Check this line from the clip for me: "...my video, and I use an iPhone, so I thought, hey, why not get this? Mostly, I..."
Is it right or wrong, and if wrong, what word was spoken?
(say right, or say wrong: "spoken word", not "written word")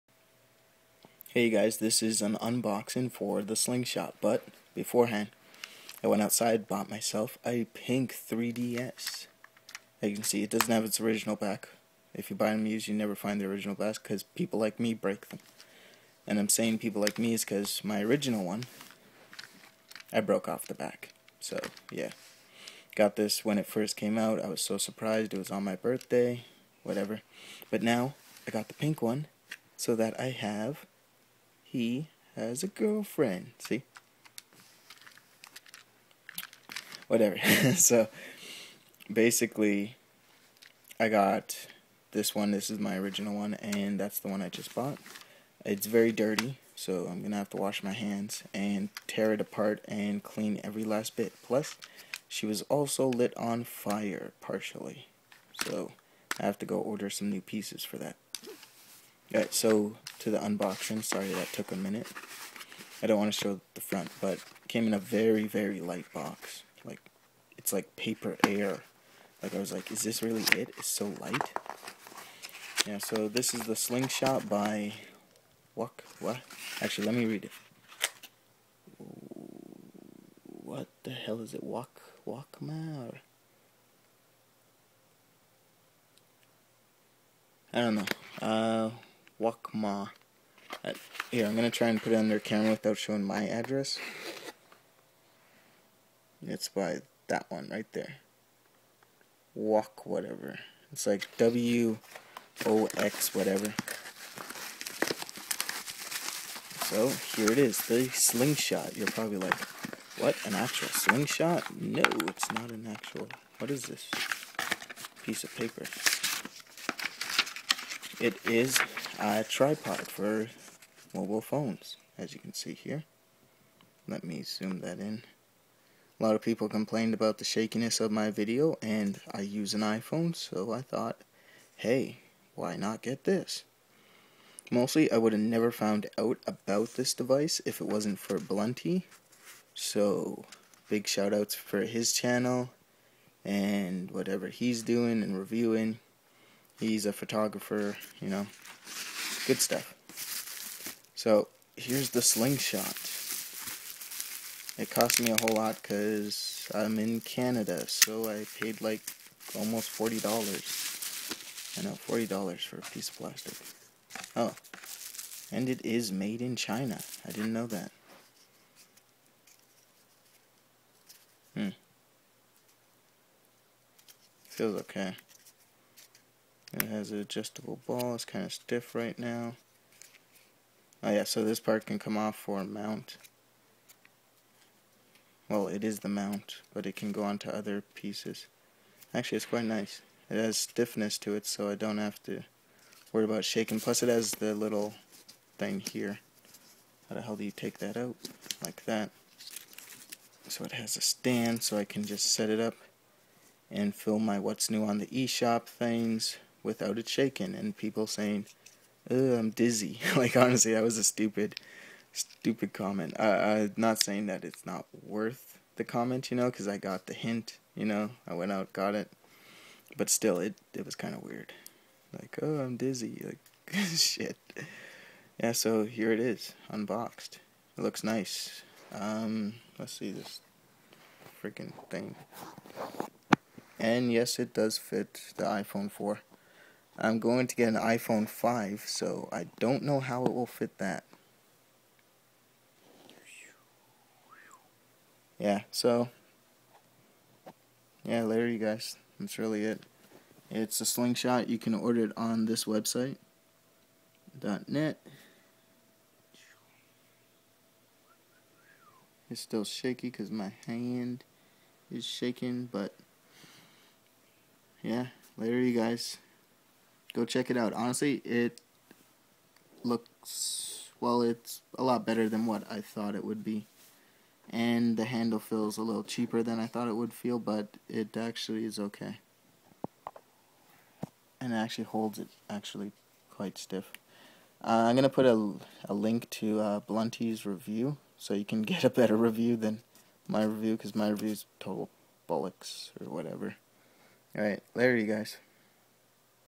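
right.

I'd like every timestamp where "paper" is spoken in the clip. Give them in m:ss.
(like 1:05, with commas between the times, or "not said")
1:07, 1:55.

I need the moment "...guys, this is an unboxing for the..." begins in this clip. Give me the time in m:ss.
0:01.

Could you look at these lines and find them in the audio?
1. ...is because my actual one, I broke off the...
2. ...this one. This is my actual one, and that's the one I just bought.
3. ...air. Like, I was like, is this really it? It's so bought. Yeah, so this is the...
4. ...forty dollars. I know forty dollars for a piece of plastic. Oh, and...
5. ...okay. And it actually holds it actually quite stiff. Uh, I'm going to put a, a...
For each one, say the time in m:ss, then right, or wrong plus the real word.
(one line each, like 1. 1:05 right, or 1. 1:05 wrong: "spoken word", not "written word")
1. 0:17 wrong: "original", not "actual"
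2. 0:42 wrong: "original", not "actual"
3. 1:08 wrong: "light", not "bought"
4. 2:39 right
5. 4:38 right.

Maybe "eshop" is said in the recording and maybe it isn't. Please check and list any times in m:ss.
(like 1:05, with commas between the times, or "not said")
3:25.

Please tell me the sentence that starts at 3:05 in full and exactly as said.
Well, it is the mount, but it can go onto other pieces.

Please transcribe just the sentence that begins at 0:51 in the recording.
Plus, she was also lit on fire partially, so I have to go order some new pieces for that.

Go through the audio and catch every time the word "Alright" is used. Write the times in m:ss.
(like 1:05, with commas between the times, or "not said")
0:59, 4:54.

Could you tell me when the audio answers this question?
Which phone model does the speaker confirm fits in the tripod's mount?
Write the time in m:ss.
3:55.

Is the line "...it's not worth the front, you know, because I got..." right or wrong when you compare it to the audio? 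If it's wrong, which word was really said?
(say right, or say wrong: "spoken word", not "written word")
wrong: "comment", not "front".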